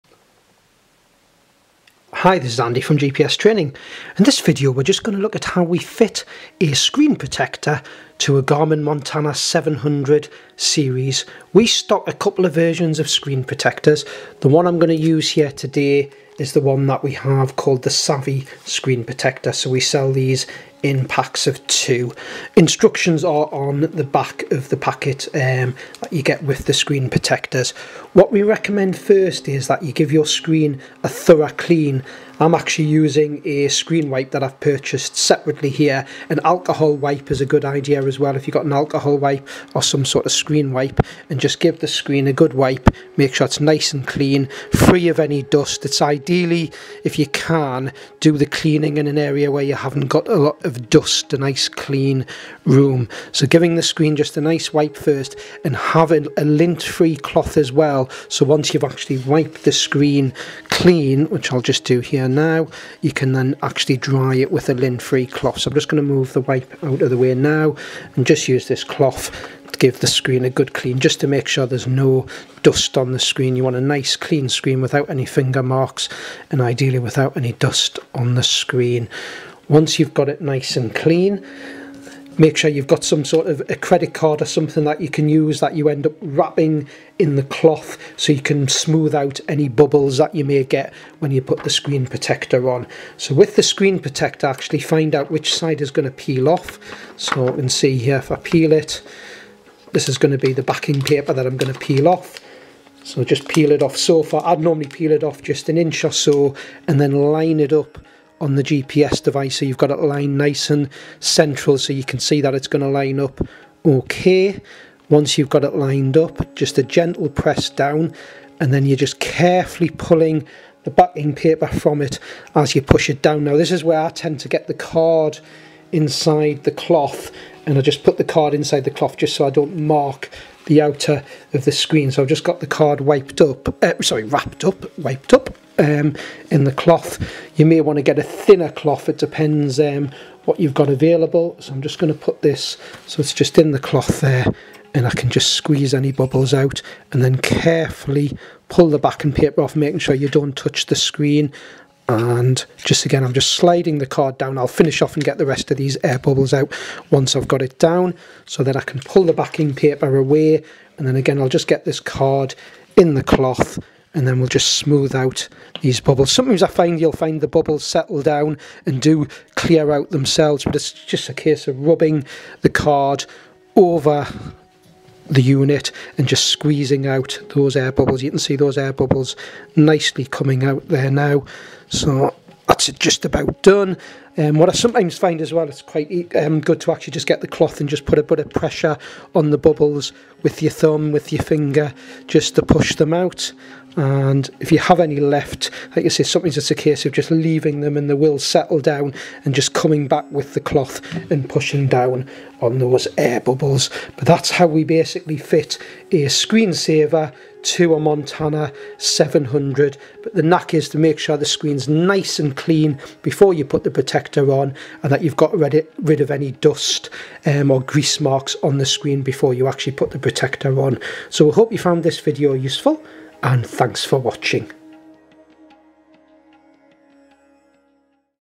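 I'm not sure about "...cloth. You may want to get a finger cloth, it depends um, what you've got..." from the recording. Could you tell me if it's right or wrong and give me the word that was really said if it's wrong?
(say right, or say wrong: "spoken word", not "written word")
wrong: "thinner", not "finger".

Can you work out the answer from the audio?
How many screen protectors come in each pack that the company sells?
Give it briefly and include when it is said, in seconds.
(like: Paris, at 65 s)
2, at 21 s.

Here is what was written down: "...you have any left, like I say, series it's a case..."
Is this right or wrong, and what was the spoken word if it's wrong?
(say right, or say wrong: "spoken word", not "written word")
wrong: "sometimes", not "series".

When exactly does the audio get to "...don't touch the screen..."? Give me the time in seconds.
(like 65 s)
150 s.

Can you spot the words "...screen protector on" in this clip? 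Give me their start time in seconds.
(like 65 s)
91 s.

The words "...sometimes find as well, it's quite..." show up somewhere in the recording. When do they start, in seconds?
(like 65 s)
184 s.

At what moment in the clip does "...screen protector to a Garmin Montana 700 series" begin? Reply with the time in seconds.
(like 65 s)
6 s.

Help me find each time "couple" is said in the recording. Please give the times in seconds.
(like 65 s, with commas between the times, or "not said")
12 s.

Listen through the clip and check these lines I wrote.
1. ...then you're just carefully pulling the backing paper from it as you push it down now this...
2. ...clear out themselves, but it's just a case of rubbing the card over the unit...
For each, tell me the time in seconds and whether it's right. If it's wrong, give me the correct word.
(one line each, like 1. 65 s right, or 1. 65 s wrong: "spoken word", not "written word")
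1. 118 s right
2. 169 s right.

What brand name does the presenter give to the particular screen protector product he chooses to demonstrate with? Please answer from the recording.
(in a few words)
Savvy.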